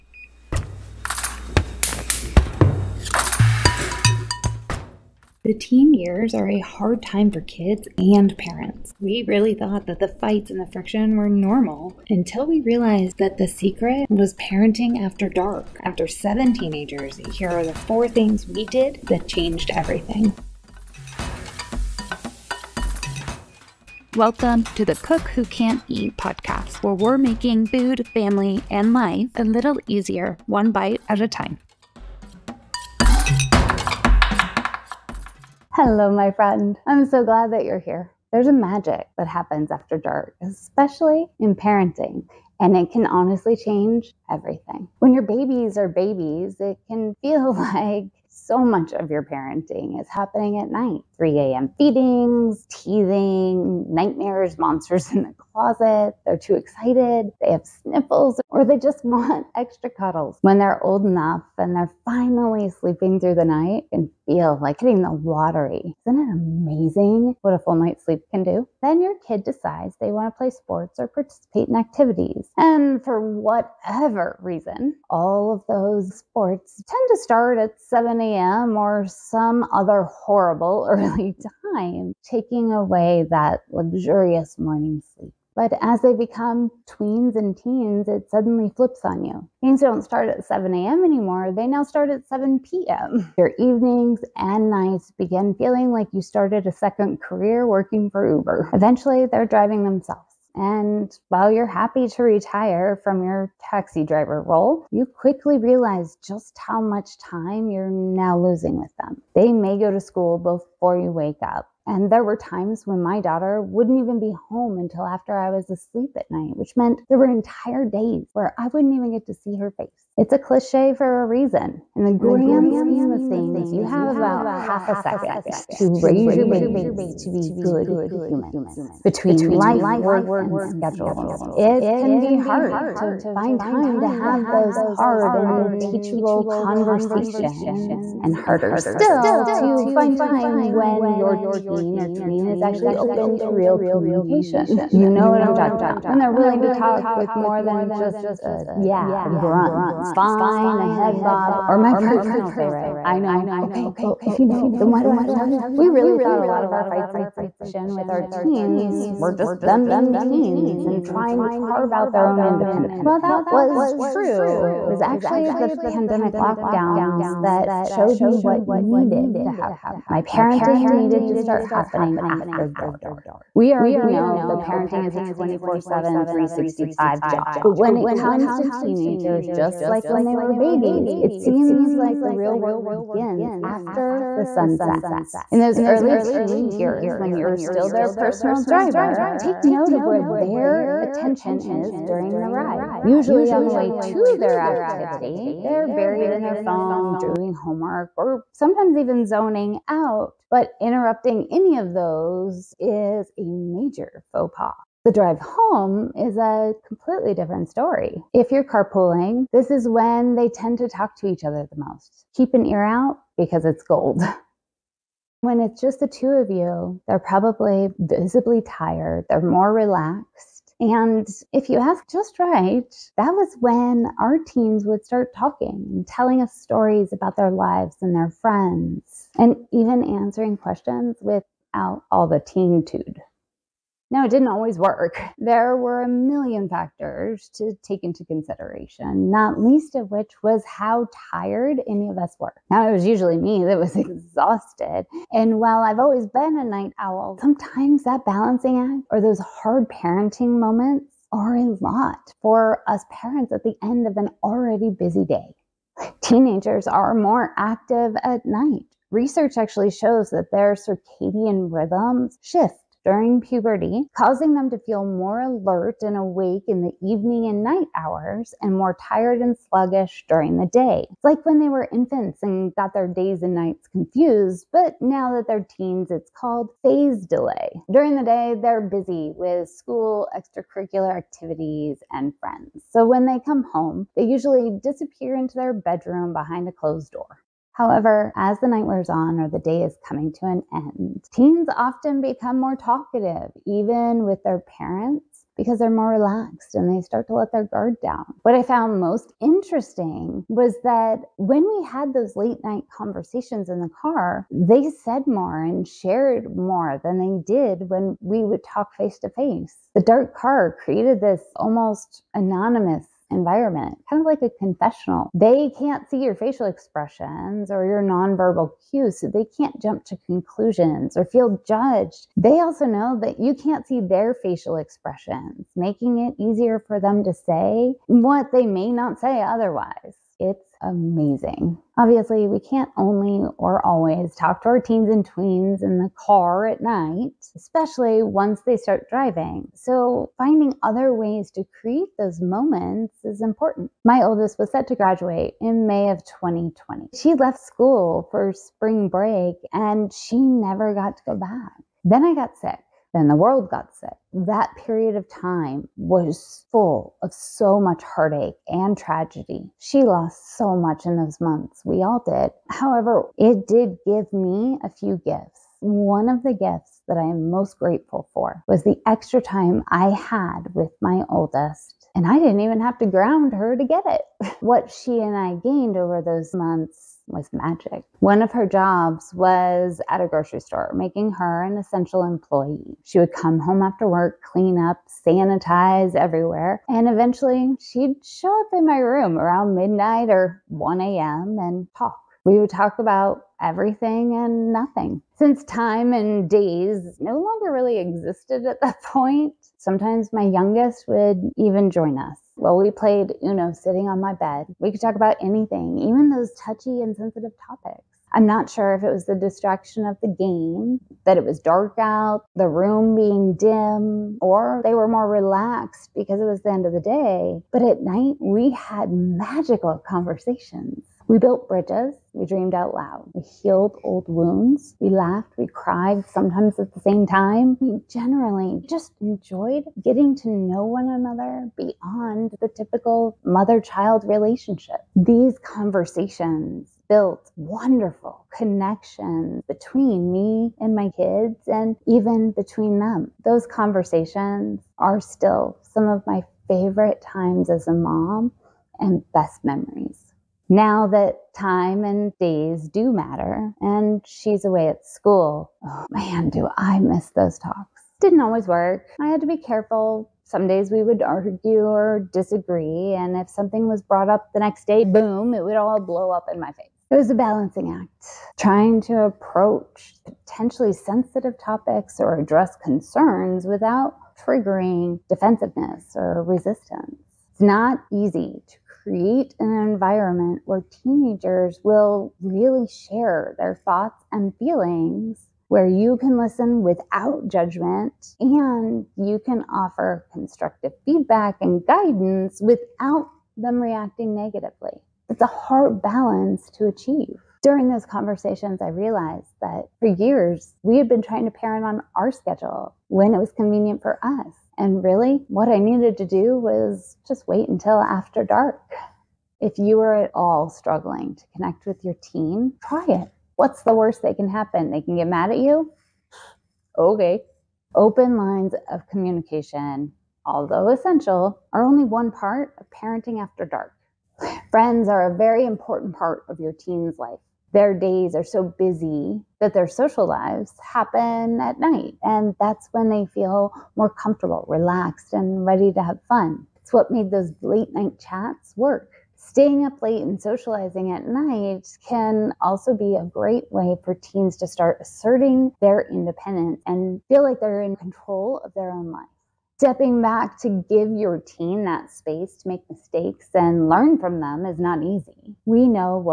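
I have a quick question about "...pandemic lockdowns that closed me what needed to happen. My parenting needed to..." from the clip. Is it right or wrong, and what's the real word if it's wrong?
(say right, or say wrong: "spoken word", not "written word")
wrong: "showed", not "closed".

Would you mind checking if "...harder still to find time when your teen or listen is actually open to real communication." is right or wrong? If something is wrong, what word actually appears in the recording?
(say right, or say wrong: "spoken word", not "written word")
wrong: "tween", not "listen".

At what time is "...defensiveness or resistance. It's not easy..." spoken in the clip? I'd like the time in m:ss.
7:55.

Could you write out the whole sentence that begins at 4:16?
Teenagers are more active at night.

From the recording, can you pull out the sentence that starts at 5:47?
She left school for spring break and she never got to go back.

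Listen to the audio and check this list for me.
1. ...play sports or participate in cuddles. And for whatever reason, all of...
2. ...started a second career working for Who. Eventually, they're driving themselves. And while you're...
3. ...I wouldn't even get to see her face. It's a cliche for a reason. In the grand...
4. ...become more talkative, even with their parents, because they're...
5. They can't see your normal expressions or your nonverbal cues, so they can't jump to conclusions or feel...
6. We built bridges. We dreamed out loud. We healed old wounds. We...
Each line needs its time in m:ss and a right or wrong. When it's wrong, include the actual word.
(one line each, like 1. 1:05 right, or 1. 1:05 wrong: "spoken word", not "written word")
1. 1:10 wrong: "activities", not "cuddles"
2. 1:36 wrong: "Uber", not "Who"
3. 1:58 right
4. 4:52 right
5. 5:15 wrong: "facial", not "normal"
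6. 7:01 right.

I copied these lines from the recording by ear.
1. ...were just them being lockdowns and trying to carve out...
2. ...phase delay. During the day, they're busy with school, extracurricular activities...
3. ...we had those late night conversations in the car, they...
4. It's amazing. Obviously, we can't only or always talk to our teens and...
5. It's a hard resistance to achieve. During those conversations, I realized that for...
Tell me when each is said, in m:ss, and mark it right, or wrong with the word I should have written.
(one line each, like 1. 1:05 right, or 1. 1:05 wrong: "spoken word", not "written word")
1. 2:39 wrong: "teens", not "lockdowns"
2. 4:36 right
3. 5:01 right
4. 5:30 right
5. 8:15 wrong: "balance", not "resistance".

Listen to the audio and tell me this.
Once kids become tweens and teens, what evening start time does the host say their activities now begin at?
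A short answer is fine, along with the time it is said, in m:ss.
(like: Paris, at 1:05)
7 p.m., at 1:32.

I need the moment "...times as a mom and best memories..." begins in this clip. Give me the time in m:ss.
7:27.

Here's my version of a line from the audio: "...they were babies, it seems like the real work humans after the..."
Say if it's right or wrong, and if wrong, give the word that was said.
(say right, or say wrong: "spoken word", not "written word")
wrong: "begins", not "humans".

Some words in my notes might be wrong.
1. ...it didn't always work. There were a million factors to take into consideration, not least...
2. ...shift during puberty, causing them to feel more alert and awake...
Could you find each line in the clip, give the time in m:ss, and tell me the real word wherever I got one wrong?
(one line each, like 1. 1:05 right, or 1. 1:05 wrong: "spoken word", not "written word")
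1. 3:54 right
2. 4:22 right.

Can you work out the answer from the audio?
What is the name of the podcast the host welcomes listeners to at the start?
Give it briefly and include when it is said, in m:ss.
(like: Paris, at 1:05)
Cook Who Can't Eat, at 0:25.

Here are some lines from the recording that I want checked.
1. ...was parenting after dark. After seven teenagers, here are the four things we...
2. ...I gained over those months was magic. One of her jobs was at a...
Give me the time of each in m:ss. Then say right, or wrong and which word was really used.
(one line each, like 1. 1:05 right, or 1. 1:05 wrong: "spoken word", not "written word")
1. 0:14 right
2. 6:15 right.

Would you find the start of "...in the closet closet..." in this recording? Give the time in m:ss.
0:55.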